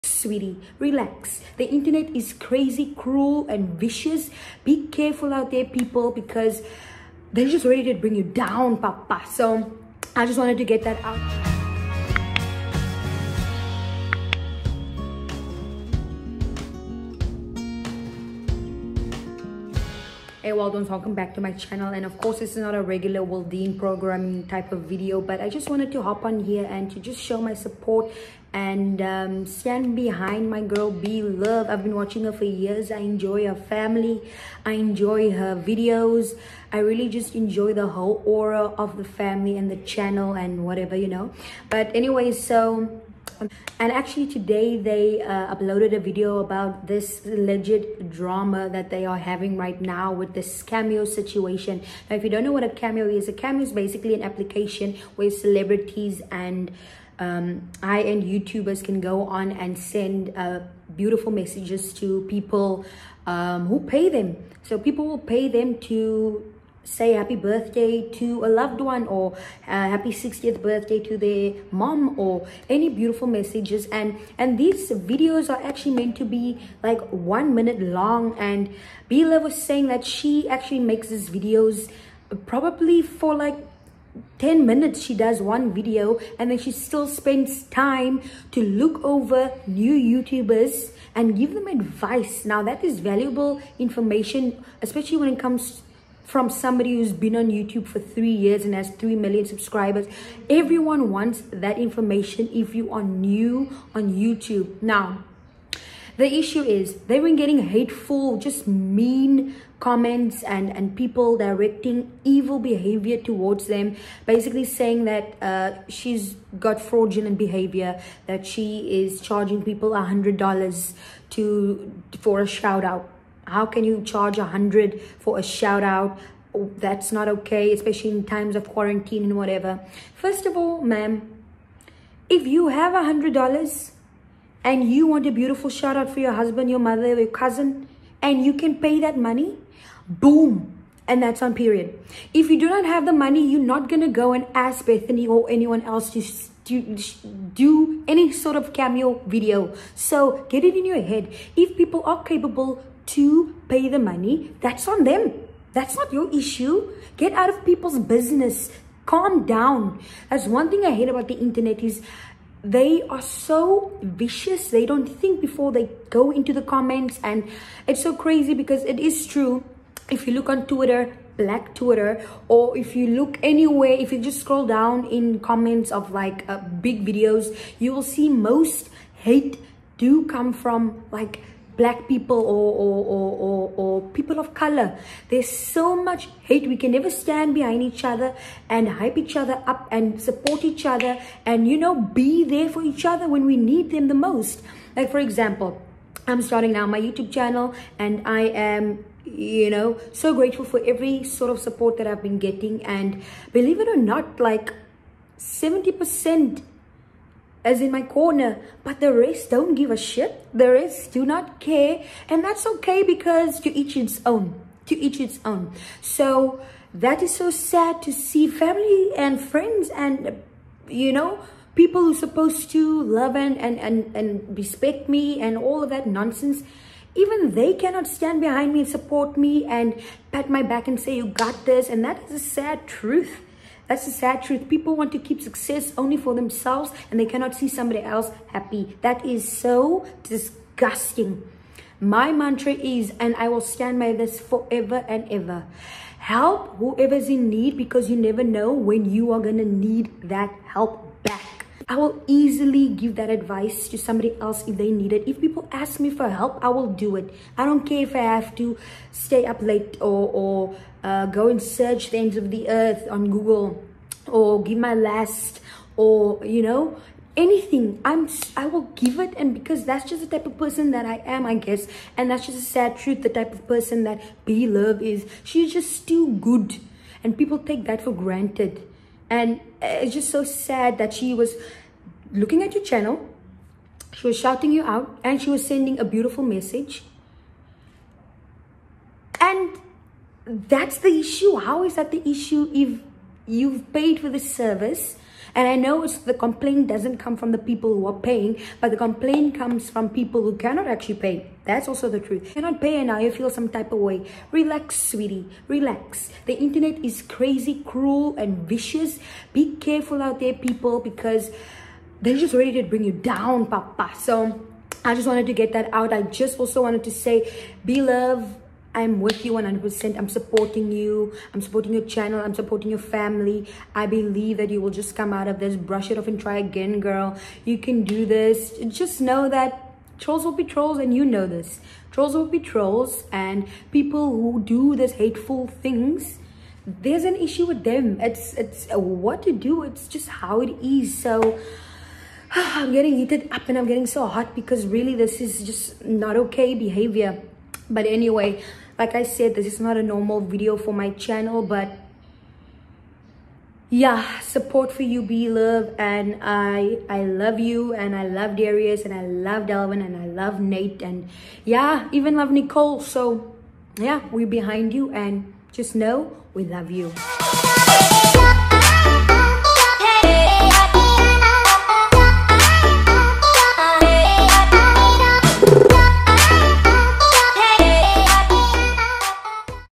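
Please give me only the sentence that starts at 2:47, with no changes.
And it's so crazy because it is true.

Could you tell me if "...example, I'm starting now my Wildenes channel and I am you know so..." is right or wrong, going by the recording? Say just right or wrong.
wrong.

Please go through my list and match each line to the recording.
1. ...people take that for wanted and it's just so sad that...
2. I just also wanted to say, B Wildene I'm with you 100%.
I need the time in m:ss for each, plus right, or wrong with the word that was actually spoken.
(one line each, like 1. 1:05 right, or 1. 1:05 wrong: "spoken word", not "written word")
1. 4:37 wrong: "granted", not "wanted"
2. 5:16 wrong: "Love", not "Wildene".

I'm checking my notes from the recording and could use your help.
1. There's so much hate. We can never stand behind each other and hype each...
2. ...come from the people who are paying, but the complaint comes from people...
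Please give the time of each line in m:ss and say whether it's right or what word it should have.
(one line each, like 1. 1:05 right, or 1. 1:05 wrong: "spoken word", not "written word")
1. 3:05 right
2. 4:57 right.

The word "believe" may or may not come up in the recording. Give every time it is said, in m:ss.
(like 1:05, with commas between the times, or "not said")
3:23, 5:24.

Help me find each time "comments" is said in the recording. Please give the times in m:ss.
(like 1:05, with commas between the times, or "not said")
1:49, 2:46, 2:55.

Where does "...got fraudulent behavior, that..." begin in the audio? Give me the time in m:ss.
1:56.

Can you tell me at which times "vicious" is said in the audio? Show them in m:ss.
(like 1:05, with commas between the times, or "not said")
0:03, 2:44, 5:08.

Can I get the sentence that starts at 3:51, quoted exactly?
And that is a sad truth that's the sad truth.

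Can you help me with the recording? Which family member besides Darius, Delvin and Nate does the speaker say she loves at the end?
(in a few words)
Nicole.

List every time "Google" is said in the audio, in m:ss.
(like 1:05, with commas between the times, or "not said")
4:23.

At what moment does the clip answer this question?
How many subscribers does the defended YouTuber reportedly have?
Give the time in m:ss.
1:38.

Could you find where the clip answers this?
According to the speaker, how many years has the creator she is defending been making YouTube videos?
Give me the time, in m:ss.
1:37.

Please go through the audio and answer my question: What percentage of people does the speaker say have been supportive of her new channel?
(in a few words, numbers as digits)
70%.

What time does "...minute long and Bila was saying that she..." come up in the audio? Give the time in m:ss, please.
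1:17.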